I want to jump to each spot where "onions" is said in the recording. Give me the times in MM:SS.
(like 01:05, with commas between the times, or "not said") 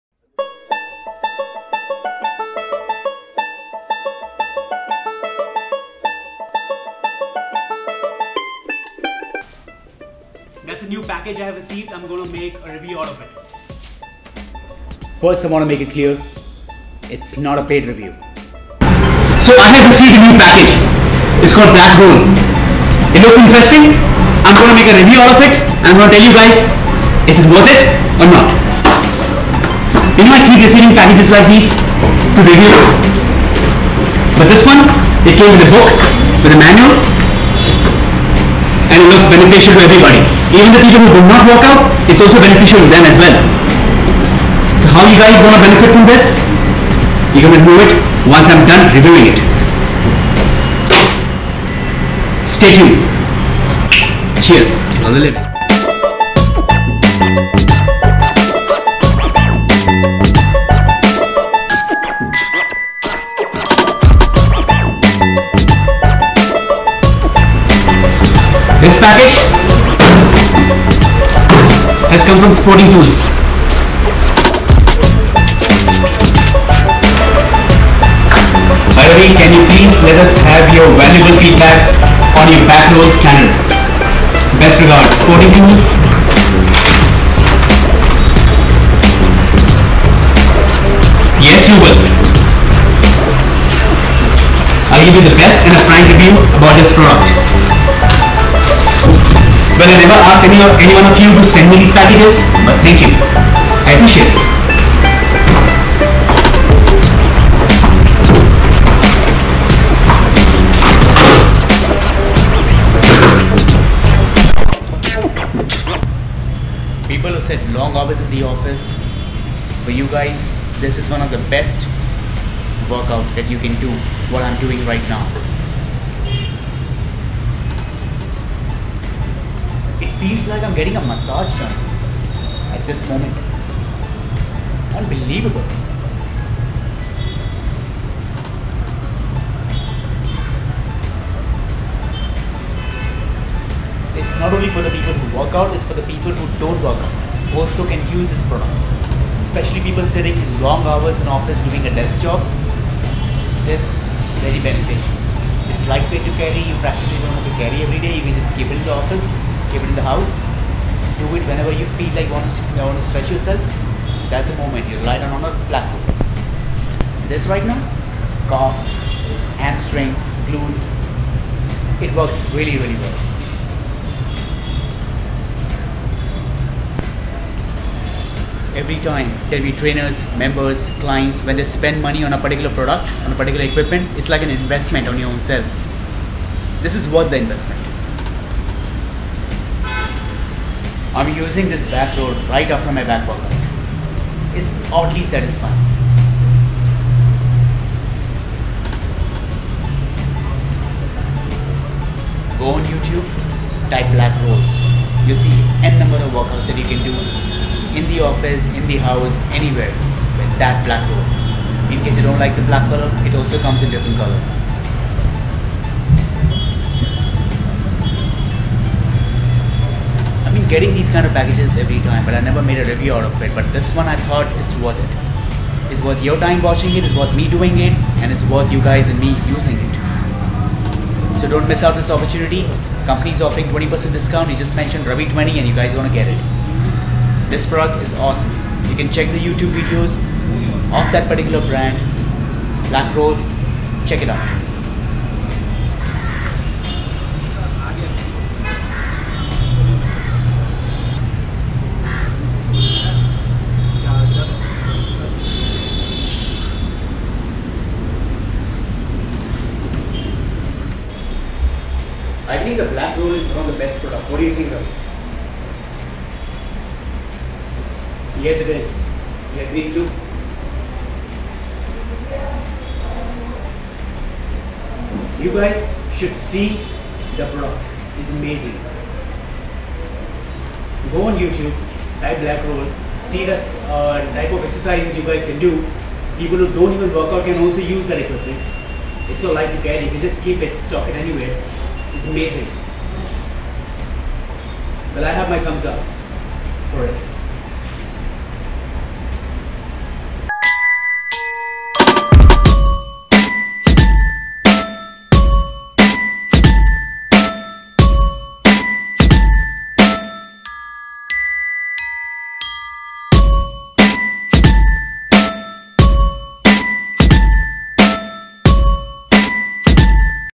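not said.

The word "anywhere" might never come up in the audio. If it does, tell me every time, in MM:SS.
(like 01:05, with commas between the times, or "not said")
03:29, 04:51.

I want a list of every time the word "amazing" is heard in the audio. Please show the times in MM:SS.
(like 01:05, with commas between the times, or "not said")
04:38, 04:52.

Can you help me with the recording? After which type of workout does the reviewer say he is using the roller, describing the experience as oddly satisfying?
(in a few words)
back workout.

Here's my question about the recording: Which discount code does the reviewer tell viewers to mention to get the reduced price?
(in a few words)
Ravi 20.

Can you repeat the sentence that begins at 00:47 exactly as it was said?
You're going to it once I'm done reviewing it.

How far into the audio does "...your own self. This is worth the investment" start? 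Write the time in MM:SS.
03:05.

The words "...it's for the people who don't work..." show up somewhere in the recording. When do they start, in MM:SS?
02:25.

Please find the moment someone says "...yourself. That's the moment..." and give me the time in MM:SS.
02:43.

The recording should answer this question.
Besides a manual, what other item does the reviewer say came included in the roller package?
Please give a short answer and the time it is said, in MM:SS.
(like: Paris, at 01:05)
a book, at 00:35.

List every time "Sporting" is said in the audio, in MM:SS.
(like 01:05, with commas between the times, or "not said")
01:12, 01:25.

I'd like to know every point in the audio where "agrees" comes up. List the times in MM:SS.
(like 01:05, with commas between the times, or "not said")
04:29.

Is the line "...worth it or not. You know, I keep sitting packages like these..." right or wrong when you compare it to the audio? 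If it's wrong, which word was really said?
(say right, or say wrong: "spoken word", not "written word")
wrong: "receiving", not "sitting".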